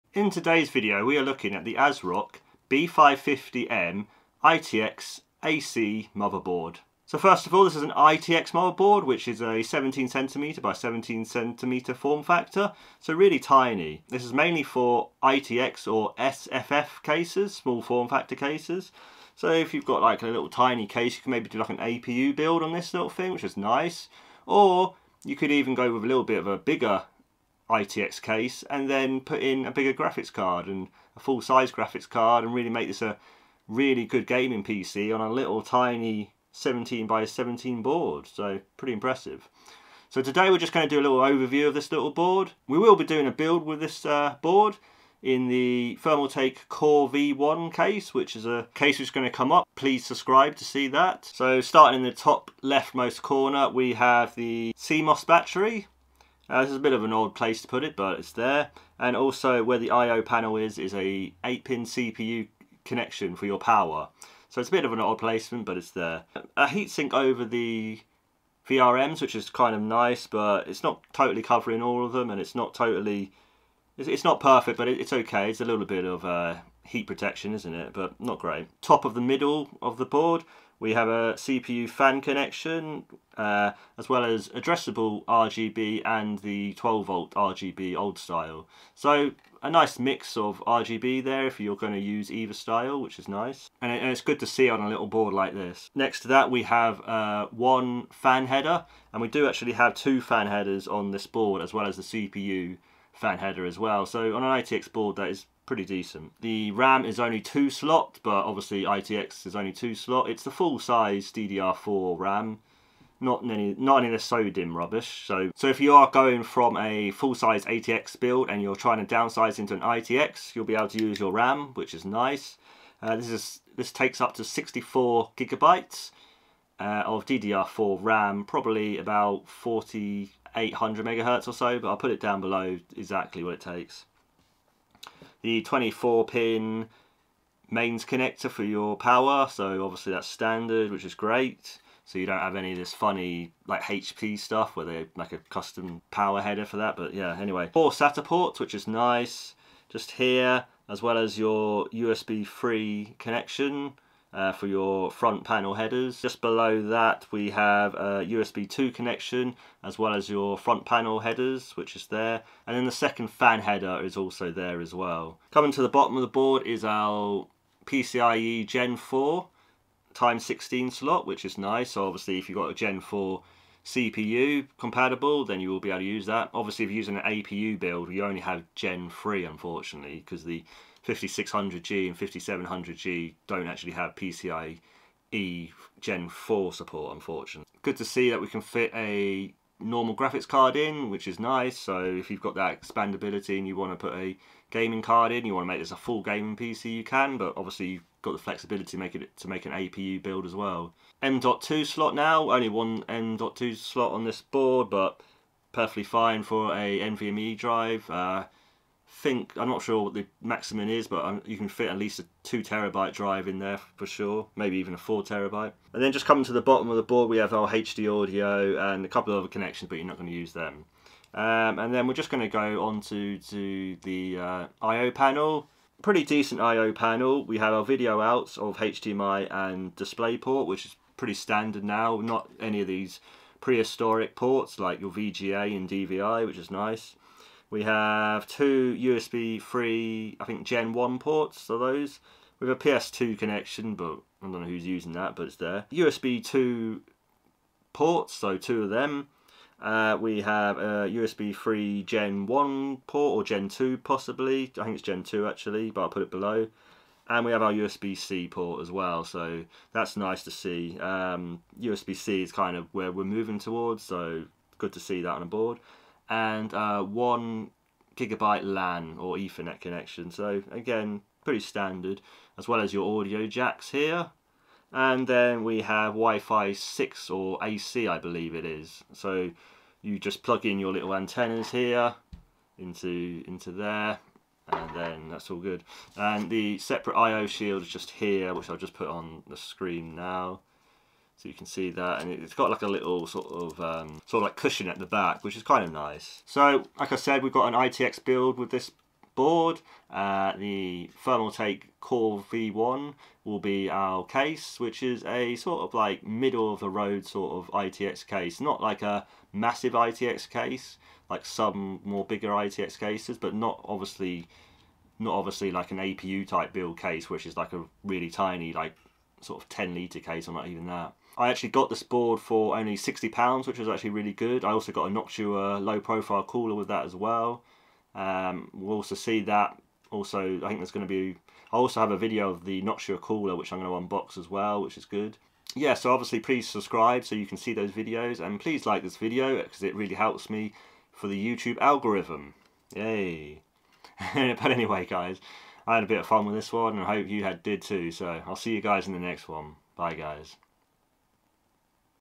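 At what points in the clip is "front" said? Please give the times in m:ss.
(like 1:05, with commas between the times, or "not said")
2:35, 2:40.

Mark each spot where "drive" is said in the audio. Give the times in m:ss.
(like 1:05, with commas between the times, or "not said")
3:27, 3:33.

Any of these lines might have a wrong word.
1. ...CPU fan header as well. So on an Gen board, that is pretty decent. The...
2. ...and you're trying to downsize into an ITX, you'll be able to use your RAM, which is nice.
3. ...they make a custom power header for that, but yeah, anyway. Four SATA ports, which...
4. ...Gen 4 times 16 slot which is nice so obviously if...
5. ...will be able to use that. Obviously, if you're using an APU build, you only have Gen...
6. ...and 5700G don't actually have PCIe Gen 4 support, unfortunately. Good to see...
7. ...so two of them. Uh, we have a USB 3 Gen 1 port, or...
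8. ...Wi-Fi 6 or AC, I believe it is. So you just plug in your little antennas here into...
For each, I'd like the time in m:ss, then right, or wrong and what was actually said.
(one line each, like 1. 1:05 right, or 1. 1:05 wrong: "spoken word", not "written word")
1. 1:42 wrong: "ITX", not "Gen"
2. 1:58 right
3. 2:24 right
4. 2:48 right
5. 2:55 right
6. 3:02 right
7. 4:08 right
8. 4:36 right.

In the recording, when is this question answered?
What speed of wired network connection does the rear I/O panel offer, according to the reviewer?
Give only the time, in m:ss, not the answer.
4:27.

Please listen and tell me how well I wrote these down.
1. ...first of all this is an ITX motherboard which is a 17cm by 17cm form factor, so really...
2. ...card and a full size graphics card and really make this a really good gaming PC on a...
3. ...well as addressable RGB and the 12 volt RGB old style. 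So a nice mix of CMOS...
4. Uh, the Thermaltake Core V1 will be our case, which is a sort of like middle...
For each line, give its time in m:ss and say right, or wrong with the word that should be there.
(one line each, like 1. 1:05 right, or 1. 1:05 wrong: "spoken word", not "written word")
1. 0:07 right
2. 0:30 right
3. 1:24 wrong: "RGB", not "CMOS"
4. 5:00 right.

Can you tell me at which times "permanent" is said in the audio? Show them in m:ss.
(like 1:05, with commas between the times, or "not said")
not said.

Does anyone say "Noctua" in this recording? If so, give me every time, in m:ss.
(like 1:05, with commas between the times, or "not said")
5:25, 5:32.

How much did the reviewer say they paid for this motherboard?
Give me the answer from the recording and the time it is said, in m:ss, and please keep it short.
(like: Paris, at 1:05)
£60, at 5:22.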